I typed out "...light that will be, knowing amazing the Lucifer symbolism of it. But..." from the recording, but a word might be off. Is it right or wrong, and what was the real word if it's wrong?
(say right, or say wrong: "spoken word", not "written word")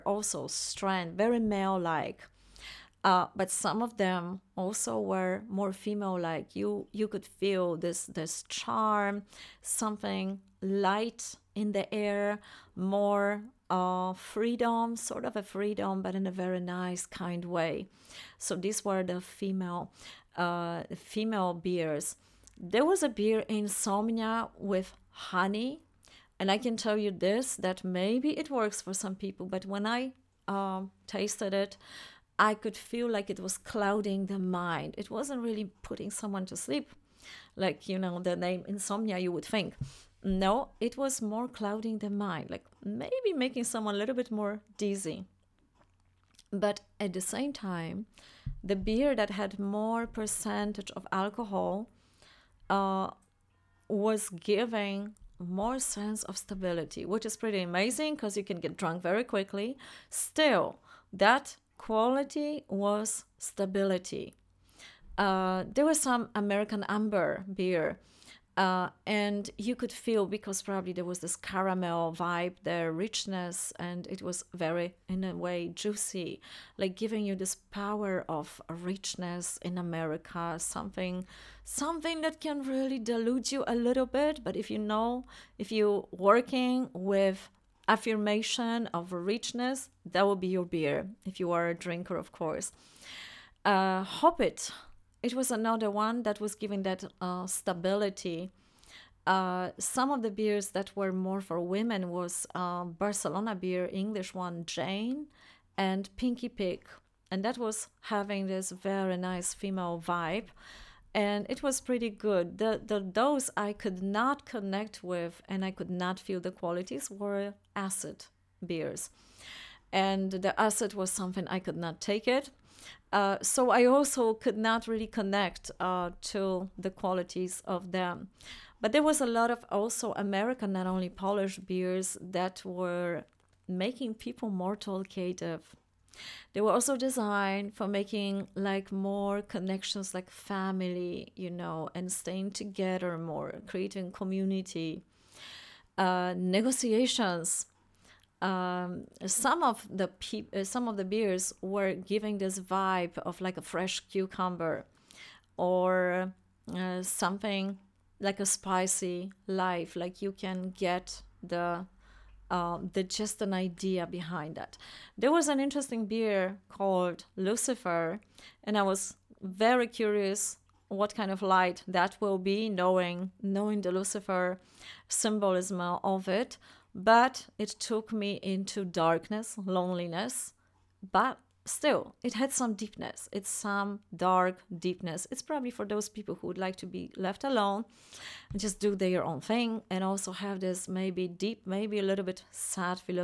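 wrong: "knowing", not "amazing".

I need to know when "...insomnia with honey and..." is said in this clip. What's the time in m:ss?
0:23.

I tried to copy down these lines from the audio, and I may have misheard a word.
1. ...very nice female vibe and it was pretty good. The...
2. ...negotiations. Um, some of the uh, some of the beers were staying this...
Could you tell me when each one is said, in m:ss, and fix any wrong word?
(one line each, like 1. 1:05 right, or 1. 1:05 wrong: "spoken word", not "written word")
1. 1:48 right
2. 2:26 wrong: "giving", not "staying".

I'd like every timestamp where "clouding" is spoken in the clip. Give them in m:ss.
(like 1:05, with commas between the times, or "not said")
0:33, 0:41.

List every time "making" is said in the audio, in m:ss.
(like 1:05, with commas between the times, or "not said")
0:43, 2:13, 2:17.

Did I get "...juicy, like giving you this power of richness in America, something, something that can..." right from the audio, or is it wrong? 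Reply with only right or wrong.
right.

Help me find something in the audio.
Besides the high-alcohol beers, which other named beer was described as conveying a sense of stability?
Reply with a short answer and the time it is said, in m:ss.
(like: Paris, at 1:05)
Hobbit, at 1:34.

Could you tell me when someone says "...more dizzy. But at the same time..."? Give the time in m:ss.
0:44.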